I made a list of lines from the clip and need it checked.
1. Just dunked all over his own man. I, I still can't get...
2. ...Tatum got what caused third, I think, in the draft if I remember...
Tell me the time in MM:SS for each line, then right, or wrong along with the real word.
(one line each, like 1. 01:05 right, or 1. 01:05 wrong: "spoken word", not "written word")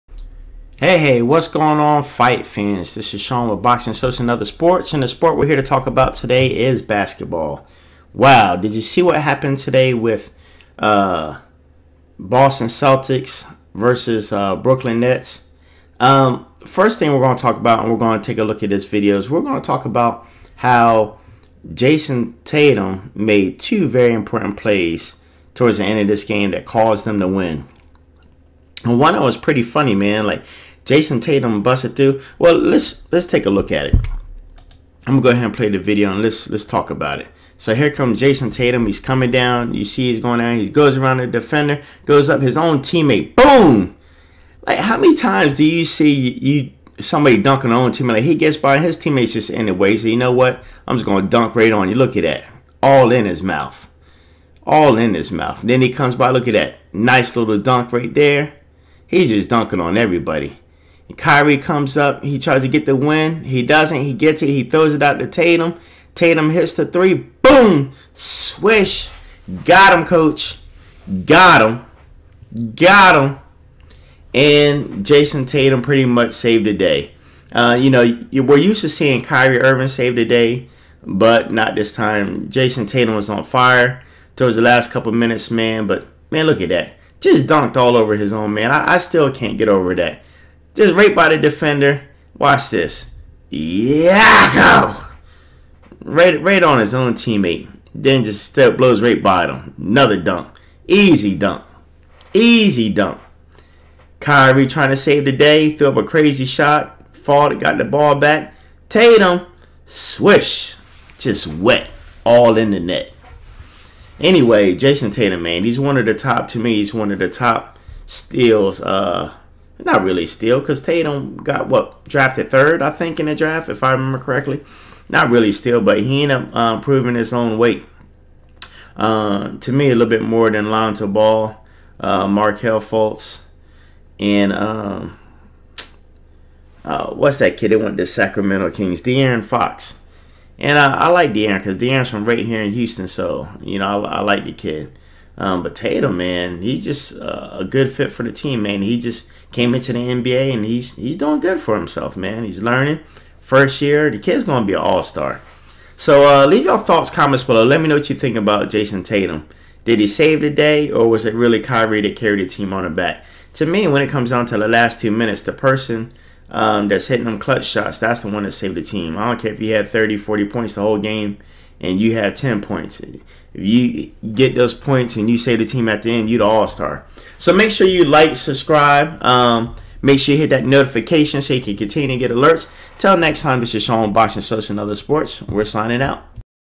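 1. 01:27 right
2. 02:00 wrong: "drafted", not "caused".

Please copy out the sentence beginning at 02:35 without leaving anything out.
So uh, leave your thoughts, comments below.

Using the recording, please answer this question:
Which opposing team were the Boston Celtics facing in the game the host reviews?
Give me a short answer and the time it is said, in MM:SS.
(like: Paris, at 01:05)
Brooklyn Nets, at 00:14.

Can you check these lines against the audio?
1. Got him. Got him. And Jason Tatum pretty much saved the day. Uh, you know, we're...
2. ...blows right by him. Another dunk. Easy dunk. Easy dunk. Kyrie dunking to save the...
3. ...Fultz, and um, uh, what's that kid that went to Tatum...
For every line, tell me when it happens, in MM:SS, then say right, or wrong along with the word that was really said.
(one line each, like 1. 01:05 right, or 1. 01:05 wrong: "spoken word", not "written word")
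1. 01:11 right
2. 01:38 wrong: "trying", not "dunking"
3. 02:12 wrong: "Sacramento", not "Tatum".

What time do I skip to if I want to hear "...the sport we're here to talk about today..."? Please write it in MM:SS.
00:05.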